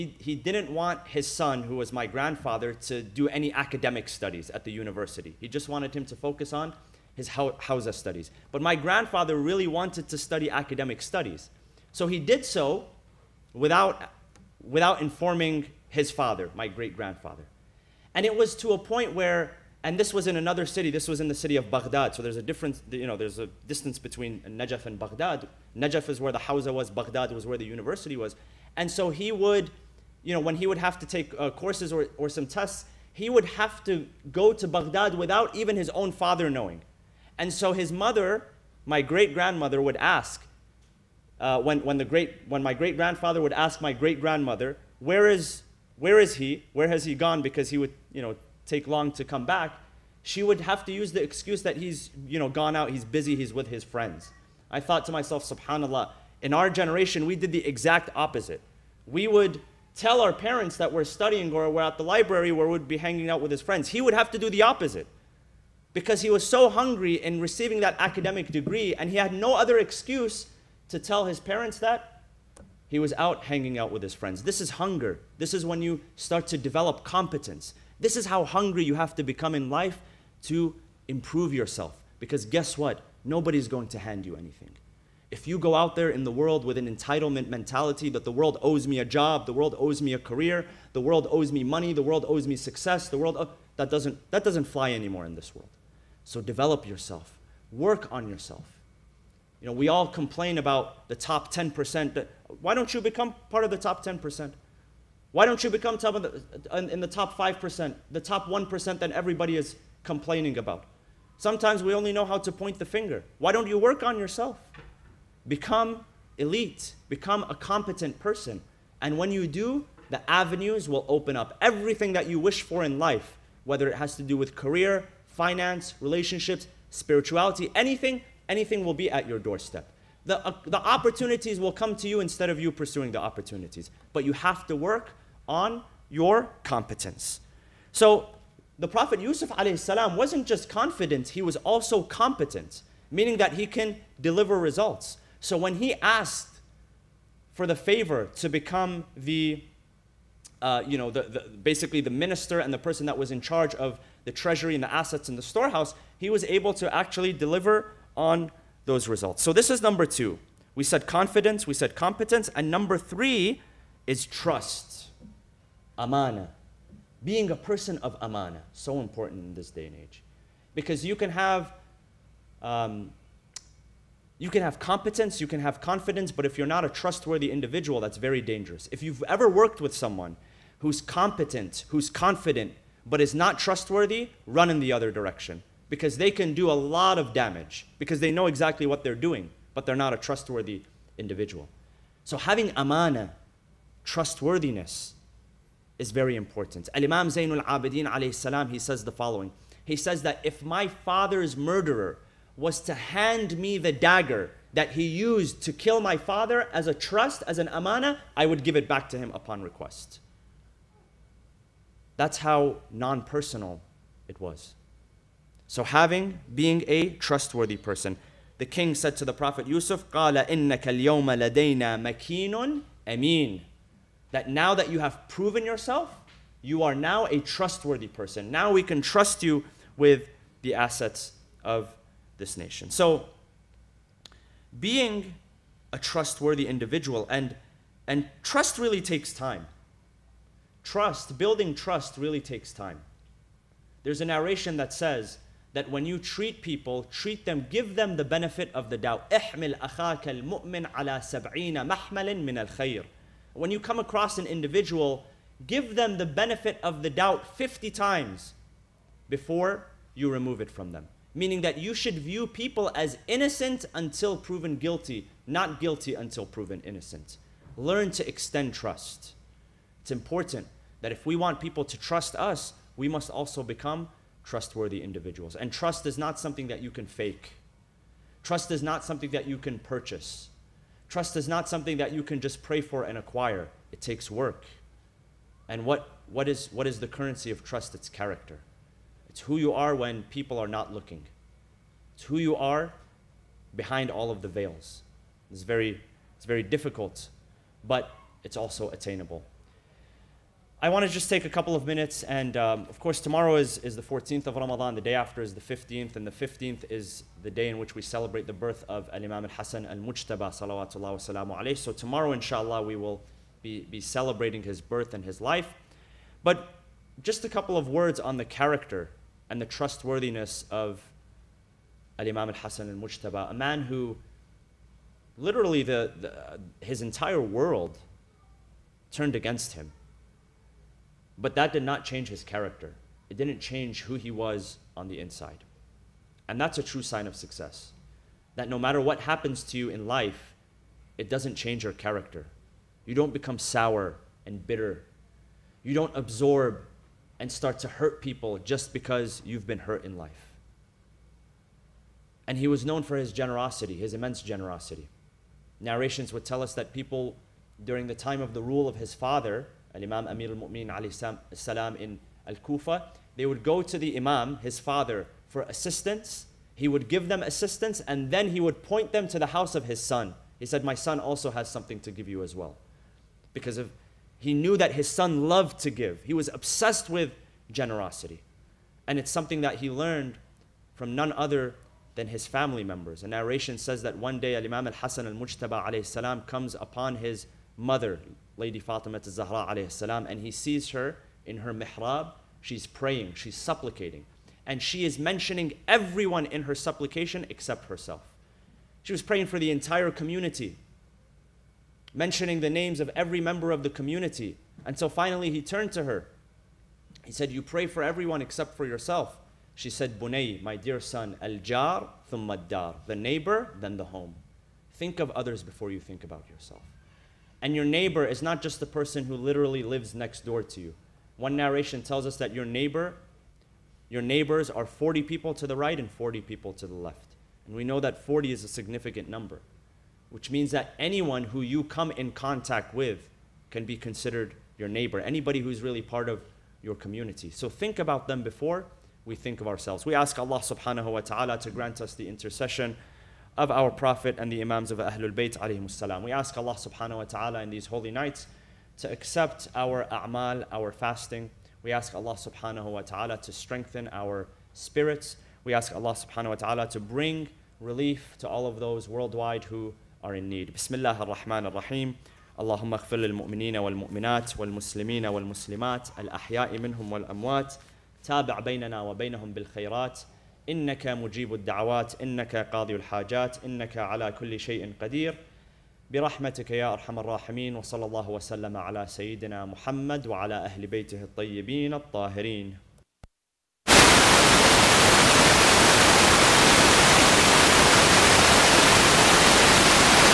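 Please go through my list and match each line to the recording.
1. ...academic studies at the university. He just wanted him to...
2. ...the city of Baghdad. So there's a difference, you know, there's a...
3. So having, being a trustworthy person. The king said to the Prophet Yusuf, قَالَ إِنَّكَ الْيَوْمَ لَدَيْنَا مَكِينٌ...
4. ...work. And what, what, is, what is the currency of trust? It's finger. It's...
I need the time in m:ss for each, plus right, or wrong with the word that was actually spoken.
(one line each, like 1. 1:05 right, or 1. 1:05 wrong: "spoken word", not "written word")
1. 0:03 right
2. 0:21 right
3. 3:35 right
4. 4:44 wrong: "character", not "finger".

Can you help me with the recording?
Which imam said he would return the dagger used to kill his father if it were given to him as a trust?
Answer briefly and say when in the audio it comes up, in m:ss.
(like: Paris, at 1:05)
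Zainul Abidin, at 3:16.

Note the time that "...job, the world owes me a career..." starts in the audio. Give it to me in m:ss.
1:29.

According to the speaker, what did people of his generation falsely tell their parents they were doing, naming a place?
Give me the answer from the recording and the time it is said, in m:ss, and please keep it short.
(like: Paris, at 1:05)
at the library, at 1:01.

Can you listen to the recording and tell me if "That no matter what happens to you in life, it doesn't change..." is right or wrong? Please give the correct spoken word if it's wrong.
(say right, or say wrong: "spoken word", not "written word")
right.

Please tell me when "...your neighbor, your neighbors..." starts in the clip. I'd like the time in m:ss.
7:02.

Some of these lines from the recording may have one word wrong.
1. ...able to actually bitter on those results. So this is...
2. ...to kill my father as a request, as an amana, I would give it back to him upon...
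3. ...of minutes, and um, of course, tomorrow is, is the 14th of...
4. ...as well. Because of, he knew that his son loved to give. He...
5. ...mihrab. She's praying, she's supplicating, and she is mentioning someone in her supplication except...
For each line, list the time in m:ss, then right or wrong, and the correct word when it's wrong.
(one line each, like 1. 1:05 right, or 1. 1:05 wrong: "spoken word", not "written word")
1. 2:36 wrong: "deliver", not "bitter"
2. 3:25 wrong: "trust", not "request"
3. 5:01 right
4. 6:12 right
5. 6:31 wrong: "everyone", not "someone".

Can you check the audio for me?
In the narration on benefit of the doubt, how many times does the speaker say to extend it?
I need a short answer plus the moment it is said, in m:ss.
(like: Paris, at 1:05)
50, at 4:17.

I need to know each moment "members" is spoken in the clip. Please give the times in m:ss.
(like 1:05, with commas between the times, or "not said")
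6:22, 6:43.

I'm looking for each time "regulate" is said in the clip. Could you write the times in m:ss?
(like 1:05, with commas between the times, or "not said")
not said.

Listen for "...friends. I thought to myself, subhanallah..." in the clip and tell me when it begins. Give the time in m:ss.
0:53.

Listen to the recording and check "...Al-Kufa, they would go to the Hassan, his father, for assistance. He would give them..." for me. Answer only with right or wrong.
wrong.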